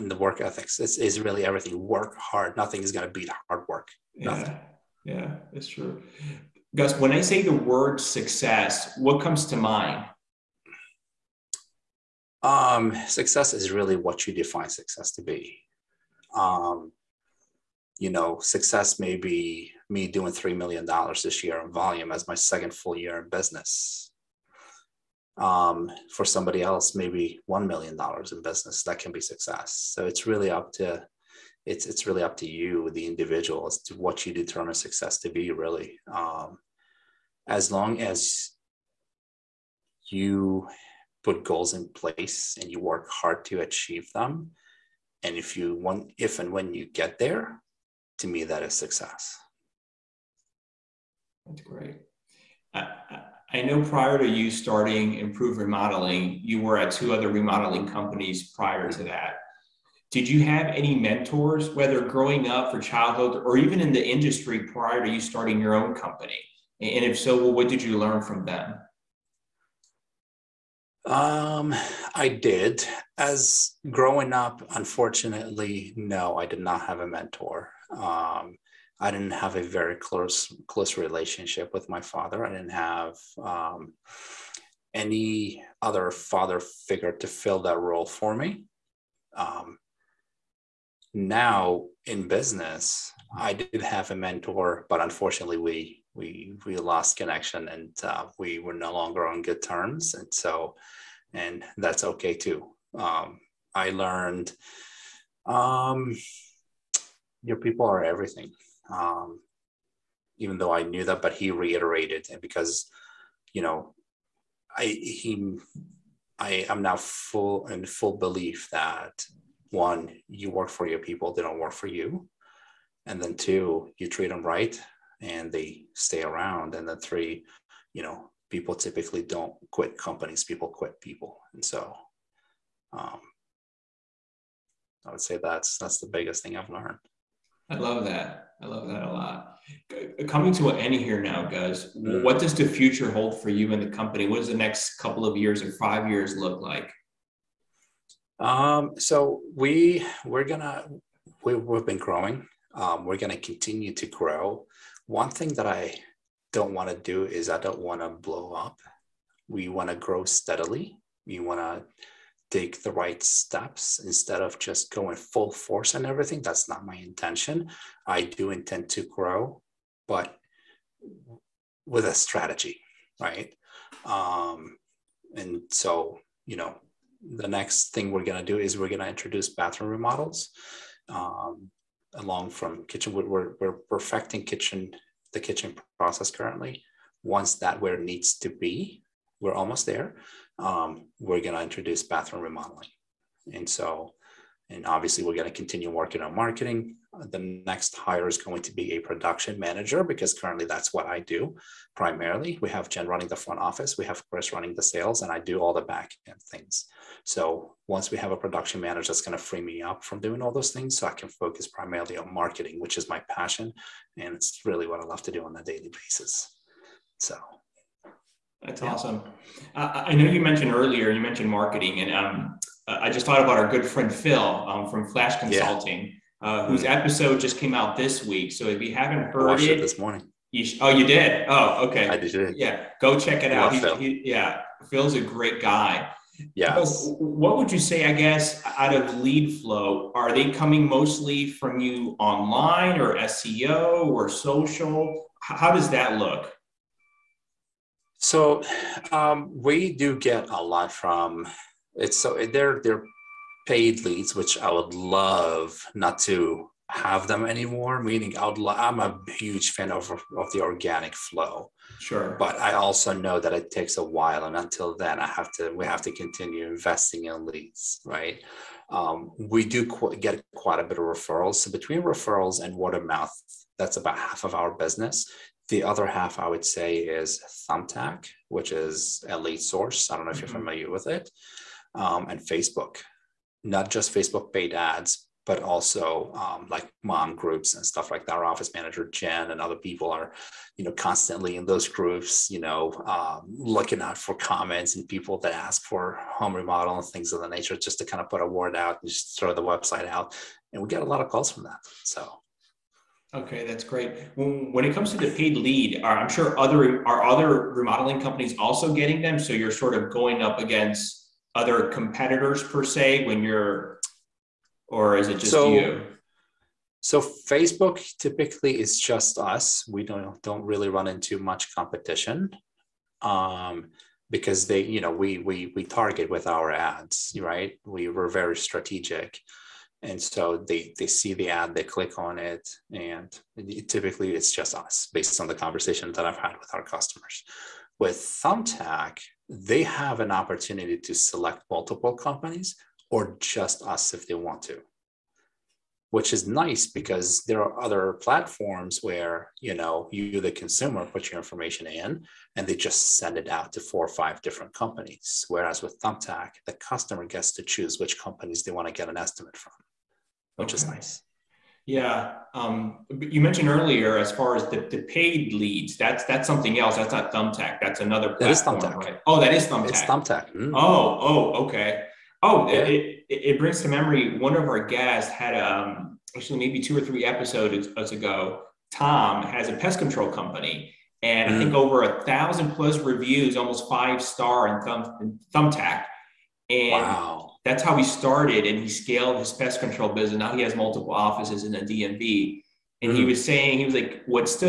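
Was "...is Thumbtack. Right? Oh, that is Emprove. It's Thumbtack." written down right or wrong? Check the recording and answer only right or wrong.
wrong.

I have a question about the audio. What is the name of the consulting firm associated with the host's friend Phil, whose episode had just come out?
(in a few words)
Flash Consulting.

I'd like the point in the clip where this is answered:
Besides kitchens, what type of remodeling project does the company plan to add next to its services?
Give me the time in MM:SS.
02:59.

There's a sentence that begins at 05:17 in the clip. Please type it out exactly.
So Facebook typically is just us.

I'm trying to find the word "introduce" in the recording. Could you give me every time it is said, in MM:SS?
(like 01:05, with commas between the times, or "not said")
02:59, 03:11.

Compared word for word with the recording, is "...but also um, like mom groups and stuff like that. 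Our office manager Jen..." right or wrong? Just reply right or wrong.
right.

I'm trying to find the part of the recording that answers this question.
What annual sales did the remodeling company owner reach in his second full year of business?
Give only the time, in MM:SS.
00:20.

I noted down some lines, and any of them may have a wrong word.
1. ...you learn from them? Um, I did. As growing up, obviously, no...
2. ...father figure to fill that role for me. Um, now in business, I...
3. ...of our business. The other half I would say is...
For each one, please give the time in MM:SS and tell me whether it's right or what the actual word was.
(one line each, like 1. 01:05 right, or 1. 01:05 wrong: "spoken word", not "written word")
1. 01:07 wrong: "unfortunately", not "obviously"
2. 01:26 right
3. 04:34 right.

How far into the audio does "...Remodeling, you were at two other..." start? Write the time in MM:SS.
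00:55.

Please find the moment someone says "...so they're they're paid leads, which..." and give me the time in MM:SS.
04:12.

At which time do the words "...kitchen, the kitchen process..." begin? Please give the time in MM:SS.
03:04.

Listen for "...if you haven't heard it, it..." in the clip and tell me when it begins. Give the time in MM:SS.
03:48.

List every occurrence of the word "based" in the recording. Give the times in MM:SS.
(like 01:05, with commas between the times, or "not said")
05:35.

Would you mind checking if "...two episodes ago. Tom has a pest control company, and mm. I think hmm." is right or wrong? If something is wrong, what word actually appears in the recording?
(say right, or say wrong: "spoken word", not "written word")
wrong: "three", not "two".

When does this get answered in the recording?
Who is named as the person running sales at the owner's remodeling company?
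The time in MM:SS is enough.
03:24.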